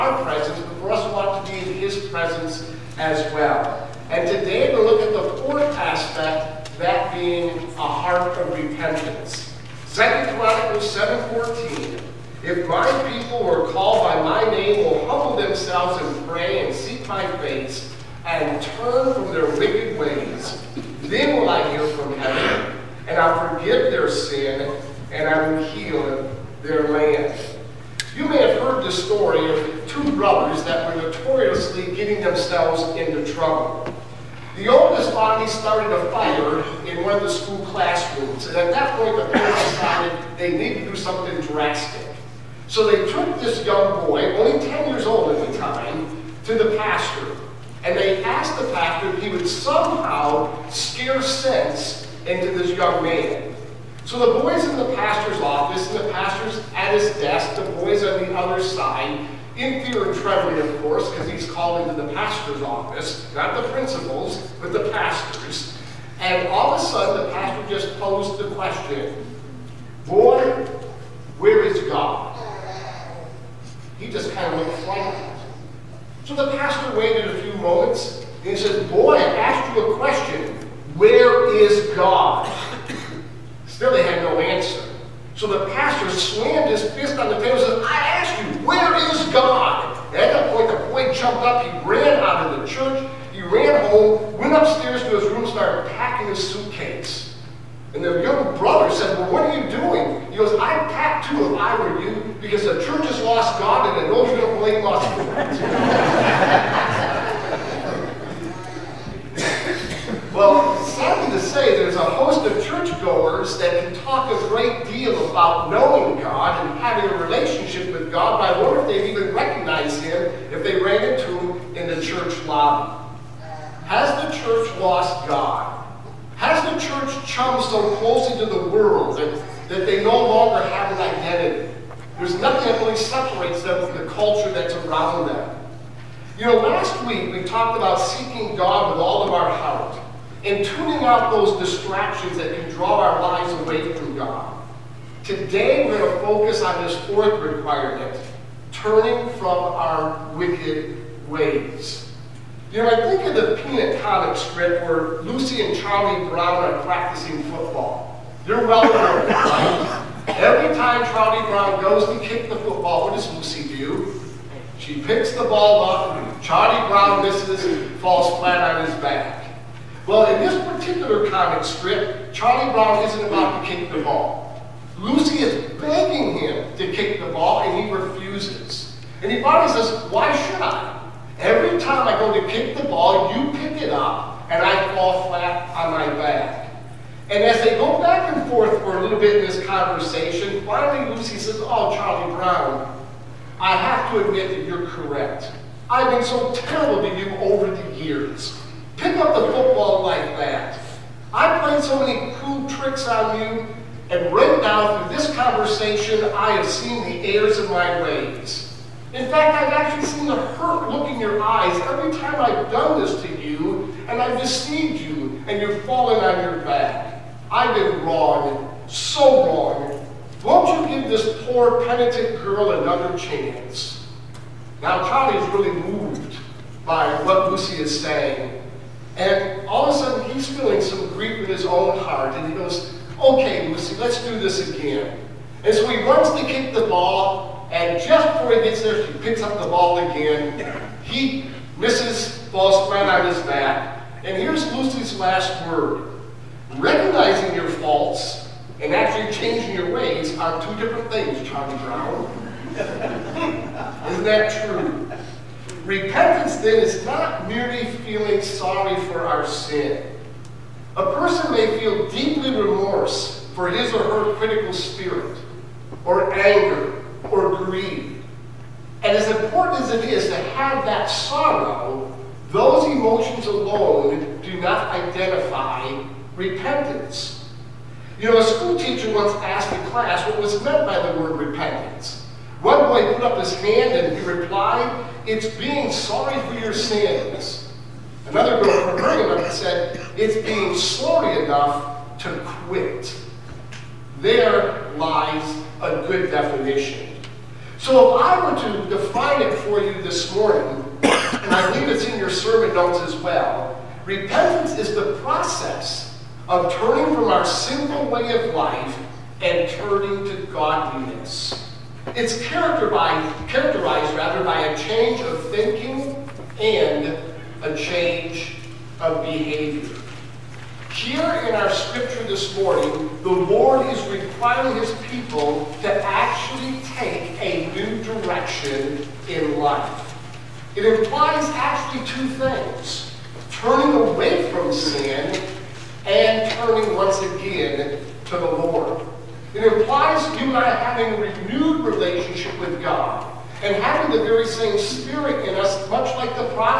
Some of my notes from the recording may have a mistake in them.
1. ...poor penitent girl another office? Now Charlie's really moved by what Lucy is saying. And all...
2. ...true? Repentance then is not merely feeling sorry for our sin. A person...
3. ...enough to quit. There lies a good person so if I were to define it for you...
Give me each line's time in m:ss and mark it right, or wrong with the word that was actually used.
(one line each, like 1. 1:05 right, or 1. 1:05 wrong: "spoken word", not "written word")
1. 3:41 wrong: "chance", not "office"
2. 4:14 right
3. 4:51 wrong: "definition", not "person".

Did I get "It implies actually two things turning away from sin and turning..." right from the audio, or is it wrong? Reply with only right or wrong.
right.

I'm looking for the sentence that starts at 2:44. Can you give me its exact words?
She picks the ball up, Charlie Brown misses, falls flat on his back.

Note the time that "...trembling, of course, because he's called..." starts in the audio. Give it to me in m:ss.
1:00.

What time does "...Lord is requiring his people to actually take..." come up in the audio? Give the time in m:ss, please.
5:23.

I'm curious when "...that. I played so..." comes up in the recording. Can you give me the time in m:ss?
3:20.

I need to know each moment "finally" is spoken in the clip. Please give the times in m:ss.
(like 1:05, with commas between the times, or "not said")
2:59, 3:10.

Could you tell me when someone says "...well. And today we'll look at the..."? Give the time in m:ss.
0:03.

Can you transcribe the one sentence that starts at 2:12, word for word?
There's nothing that really separates them from the culture that's around them.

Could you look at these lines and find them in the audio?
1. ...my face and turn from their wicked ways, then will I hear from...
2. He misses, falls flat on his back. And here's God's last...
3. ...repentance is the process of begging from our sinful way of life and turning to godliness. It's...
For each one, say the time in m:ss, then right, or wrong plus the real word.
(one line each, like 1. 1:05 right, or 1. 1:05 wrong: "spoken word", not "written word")
1. 0:17 right
2. 4:01 wrong: "Lucy", not "God"
3. 5:04 wrong: "turning", not "begging".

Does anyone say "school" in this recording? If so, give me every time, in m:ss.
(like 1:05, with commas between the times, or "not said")
0:37, 4:38.